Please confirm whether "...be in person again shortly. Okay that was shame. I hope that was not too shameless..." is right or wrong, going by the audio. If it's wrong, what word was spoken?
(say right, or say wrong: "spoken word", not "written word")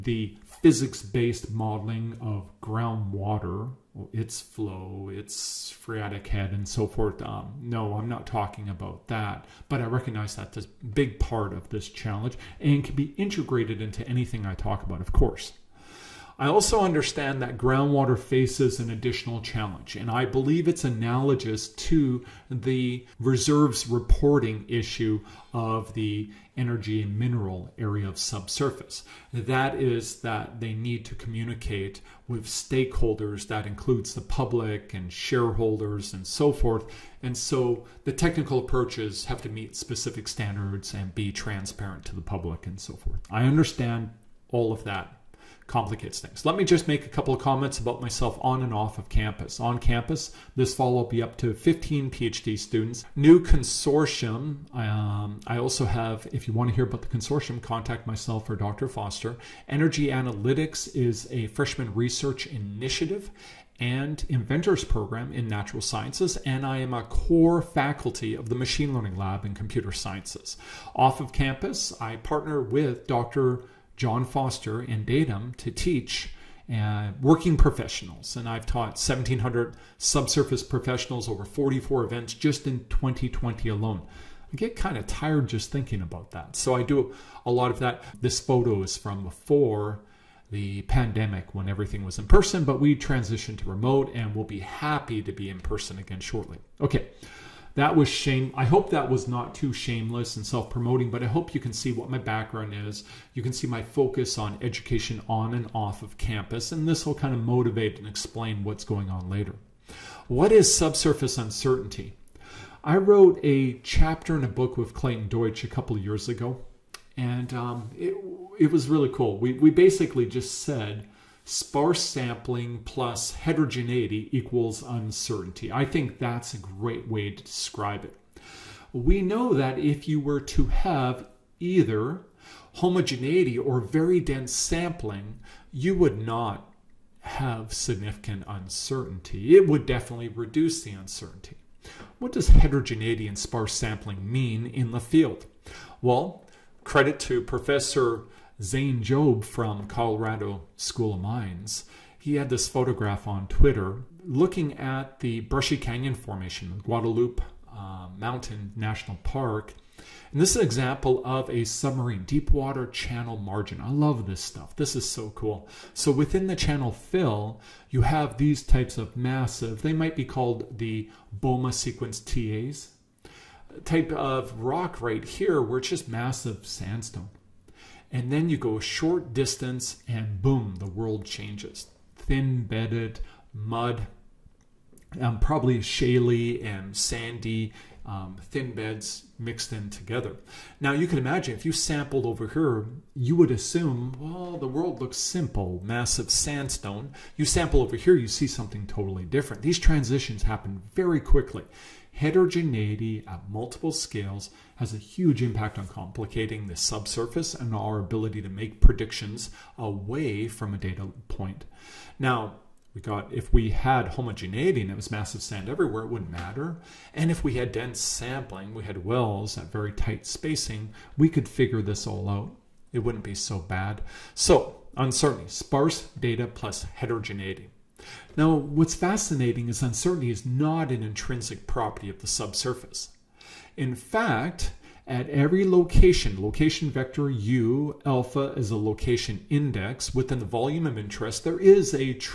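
right.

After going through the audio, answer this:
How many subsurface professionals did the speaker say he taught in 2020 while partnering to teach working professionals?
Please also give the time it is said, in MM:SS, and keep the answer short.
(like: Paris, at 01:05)
1,700, at 01:18.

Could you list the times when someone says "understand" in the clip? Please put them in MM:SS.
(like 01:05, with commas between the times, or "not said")
00:16, 00:43.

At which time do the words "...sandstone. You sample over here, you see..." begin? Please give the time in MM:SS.
03:16.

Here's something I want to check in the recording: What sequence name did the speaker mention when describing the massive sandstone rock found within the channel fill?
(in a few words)
Bouma sequence.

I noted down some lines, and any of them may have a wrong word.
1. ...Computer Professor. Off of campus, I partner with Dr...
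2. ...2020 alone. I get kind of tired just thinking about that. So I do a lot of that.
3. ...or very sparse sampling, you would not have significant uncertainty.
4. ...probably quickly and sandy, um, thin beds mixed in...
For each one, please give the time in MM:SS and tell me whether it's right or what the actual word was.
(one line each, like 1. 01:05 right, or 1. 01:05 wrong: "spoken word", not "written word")
1. 01:09 wrong: "Sciences", not "Professor"
2. 01:22 right
3. 02:13 wrong: "dense", not "sparse"
4. 03:05 wrong: "shaly", not "quickly".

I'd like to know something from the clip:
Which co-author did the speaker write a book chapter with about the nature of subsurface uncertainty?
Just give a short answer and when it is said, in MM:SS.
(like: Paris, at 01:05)
Clayton Deutsch, at 01:54.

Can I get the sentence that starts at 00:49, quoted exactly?
On campus, this fall will be up to 15 PhD students.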